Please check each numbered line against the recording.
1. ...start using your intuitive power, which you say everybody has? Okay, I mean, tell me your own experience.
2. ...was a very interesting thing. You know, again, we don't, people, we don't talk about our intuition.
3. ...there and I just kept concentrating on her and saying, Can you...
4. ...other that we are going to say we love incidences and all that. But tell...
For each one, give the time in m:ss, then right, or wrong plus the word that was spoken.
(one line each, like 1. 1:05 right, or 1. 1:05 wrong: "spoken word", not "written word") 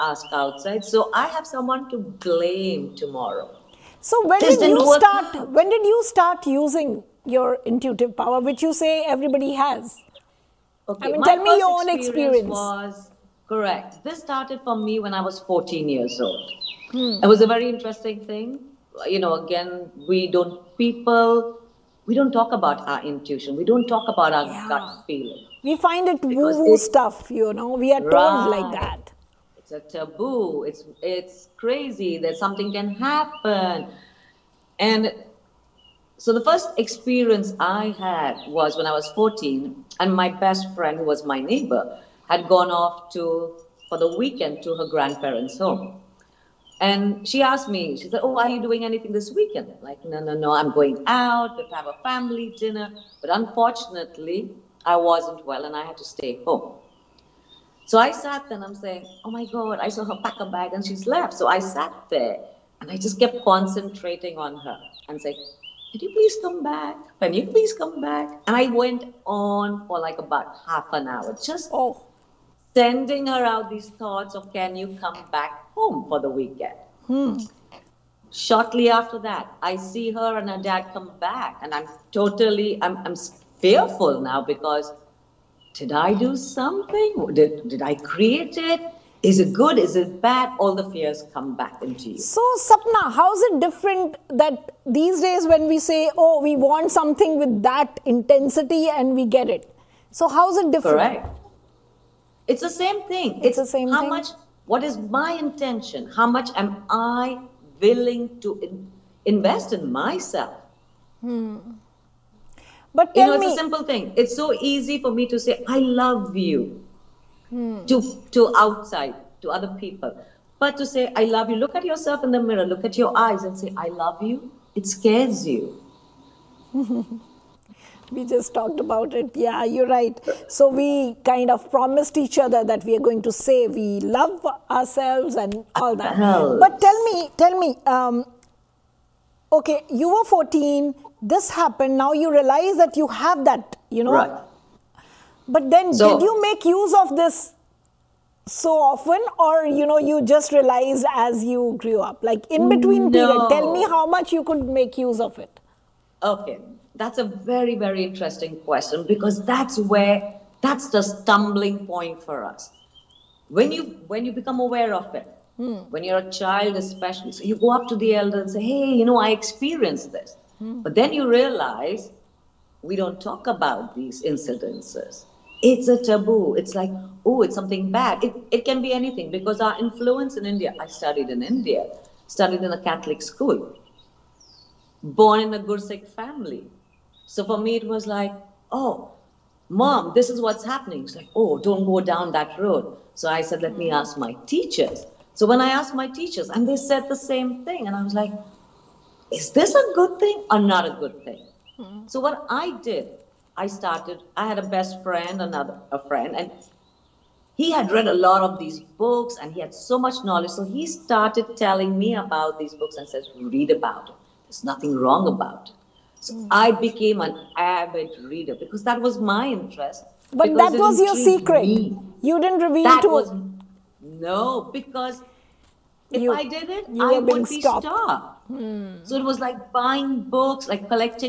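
1. 0:06 right
2. 0:17 right
3. 1:02 right
4. 2:12 wrong: "ourselves", not "incidences".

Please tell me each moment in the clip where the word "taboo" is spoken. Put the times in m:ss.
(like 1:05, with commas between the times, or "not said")
0:29, 2:56.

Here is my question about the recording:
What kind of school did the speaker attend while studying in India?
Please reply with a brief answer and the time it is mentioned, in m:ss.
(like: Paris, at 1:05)
Catholic school, at 3:02.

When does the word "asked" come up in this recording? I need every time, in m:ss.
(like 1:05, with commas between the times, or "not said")
0:47, 3:15.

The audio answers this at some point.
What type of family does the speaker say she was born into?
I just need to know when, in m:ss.
3:05.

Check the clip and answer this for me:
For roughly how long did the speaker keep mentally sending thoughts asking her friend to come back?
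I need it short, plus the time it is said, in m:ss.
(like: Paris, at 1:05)
Half an hour, at 1:10.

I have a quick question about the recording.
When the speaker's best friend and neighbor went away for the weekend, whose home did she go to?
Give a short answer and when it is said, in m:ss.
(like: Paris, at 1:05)
Her grandparents' home, at 0:44.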